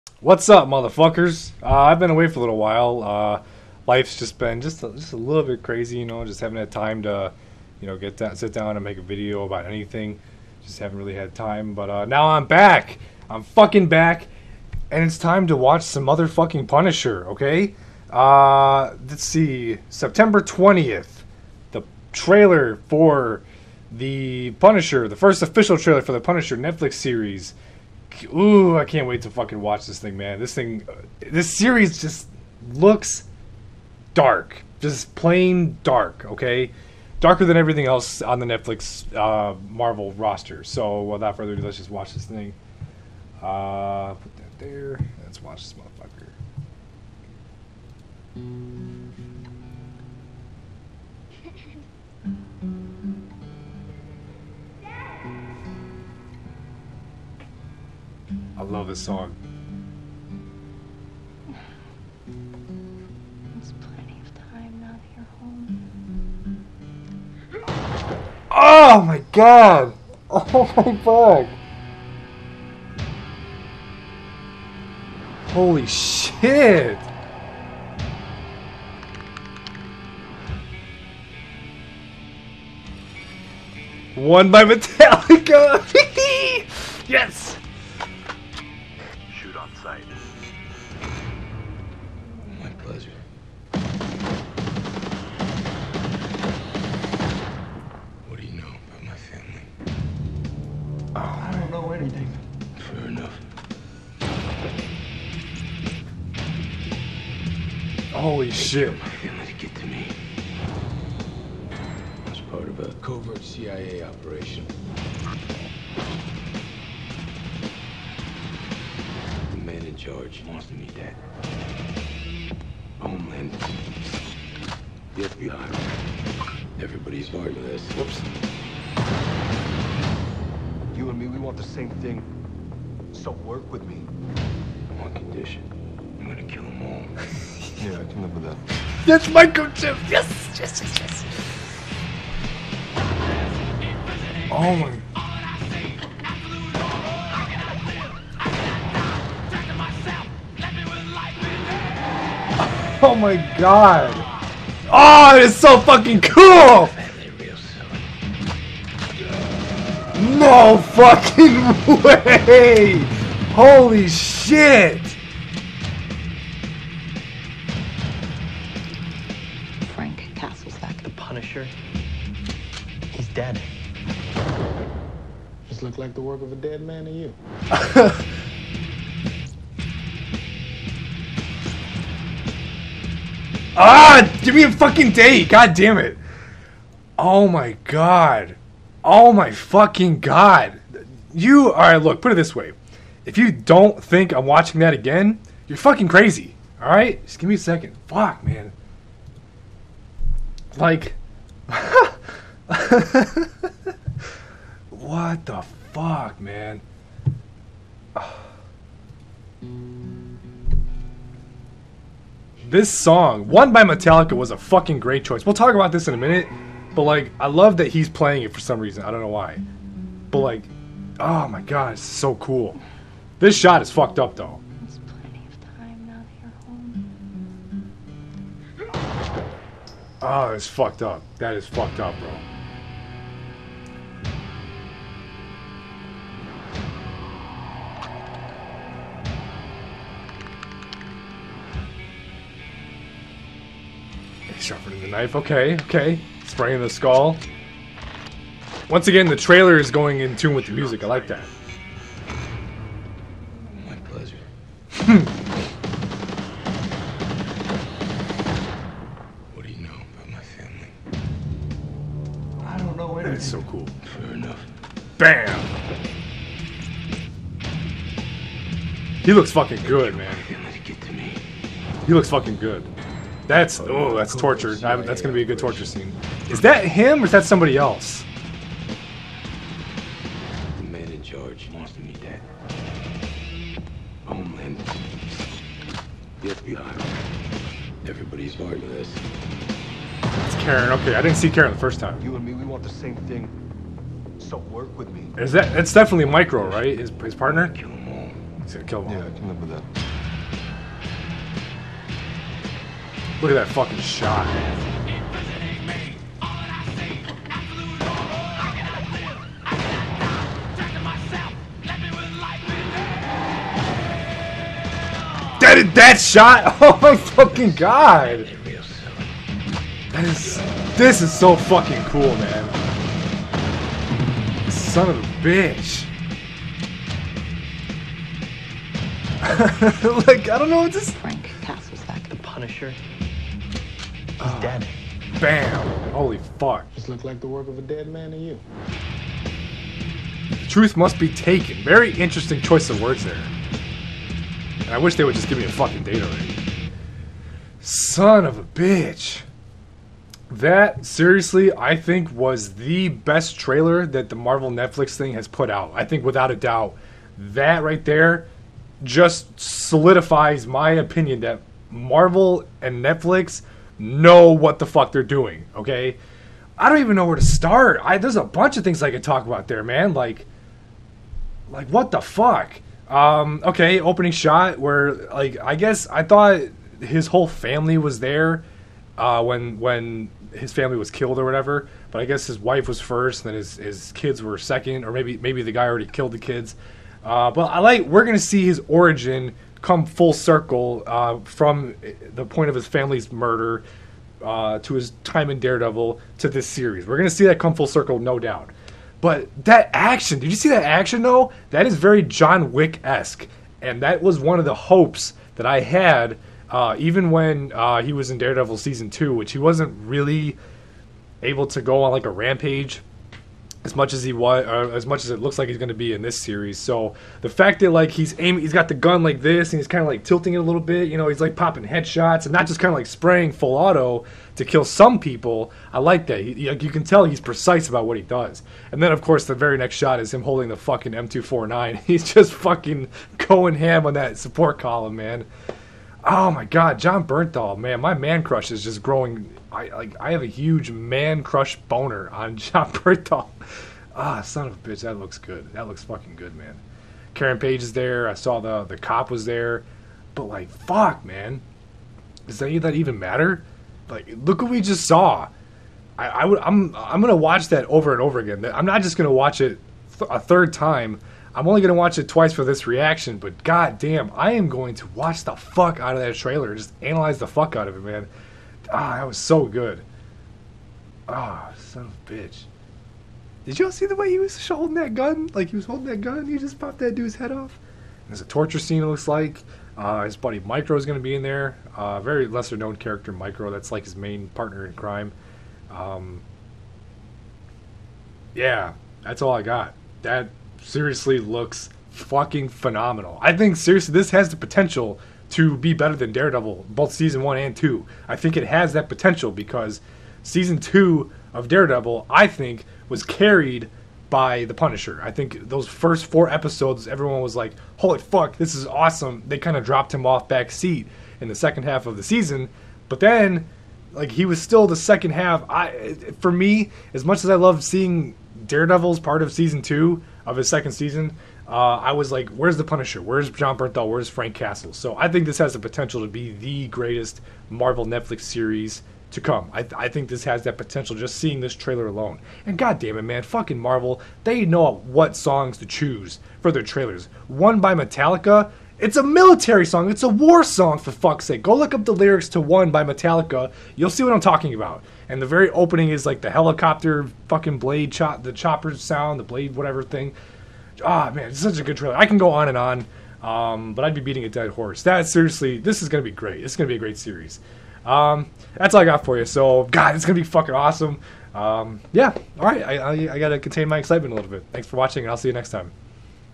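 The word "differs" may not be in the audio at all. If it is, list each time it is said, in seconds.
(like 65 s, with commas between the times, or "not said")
not said.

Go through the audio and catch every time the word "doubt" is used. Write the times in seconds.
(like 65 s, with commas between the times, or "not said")
356 s, 398 s.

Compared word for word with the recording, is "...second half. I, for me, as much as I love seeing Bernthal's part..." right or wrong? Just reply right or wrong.
wrong.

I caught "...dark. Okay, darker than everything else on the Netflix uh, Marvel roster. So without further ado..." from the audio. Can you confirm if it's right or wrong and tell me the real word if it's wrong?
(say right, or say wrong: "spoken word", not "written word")
right.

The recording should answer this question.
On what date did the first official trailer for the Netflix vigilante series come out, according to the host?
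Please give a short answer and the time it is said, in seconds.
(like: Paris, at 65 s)
September 20, at 19 s.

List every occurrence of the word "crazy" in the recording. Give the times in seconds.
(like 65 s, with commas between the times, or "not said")
5 s, 196 s.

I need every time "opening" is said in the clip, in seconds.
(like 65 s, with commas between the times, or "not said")
374 s, 545 s.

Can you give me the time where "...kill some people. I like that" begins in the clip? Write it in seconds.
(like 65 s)
424 s.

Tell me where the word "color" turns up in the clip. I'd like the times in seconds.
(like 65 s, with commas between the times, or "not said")
not said.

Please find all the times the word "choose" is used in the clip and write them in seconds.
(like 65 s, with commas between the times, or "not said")
535 s.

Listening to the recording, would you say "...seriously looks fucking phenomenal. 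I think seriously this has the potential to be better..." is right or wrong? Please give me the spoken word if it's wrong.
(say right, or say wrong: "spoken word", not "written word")
right.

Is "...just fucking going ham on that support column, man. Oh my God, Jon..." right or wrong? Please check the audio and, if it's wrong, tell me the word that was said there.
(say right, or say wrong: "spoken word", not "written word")
right.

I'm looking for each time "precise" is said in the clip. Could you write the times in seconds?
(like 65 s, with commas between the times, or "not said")
427 s.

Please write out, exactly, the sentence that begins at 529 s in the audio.
I, th- I think this has that potential just seeing this trailer alone.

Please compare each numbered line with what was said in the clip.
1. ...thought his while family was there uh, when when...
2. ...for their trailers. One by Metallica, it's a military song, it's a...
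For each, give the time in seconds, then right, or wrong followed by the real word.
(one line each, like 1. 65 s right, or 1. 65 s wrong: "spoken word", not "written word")
1. 376 s wrong: "whole", not "while"
2. 536 s right.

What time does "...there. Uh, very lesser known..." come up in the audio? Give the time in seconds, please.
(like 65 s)
481 s.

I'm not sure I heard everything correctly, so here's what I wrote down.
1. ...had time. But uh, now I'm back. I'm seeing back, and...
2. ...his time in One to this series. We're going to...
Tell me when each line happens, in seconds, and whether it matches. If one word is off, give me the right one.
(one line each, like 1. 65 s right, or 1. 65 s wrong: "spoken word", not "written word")
1. 11 s wrong: "fucking", not "seeing"
2. 394 s wrong: "Daredevil", not "One".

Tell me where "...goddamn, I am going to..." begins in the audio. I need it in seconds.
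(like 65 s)
463 s.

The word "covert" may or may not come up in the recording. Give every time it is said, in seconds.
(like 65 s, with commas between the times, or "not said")
113 s.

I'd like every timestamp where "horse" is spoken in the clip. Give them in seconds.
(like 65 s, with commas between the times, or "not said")
554 s.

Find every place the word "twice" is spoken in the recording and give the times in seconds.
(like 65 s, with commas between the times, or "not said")
462 s.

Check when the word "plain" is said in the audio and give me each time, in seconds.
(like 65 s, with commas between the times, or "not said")
35 s.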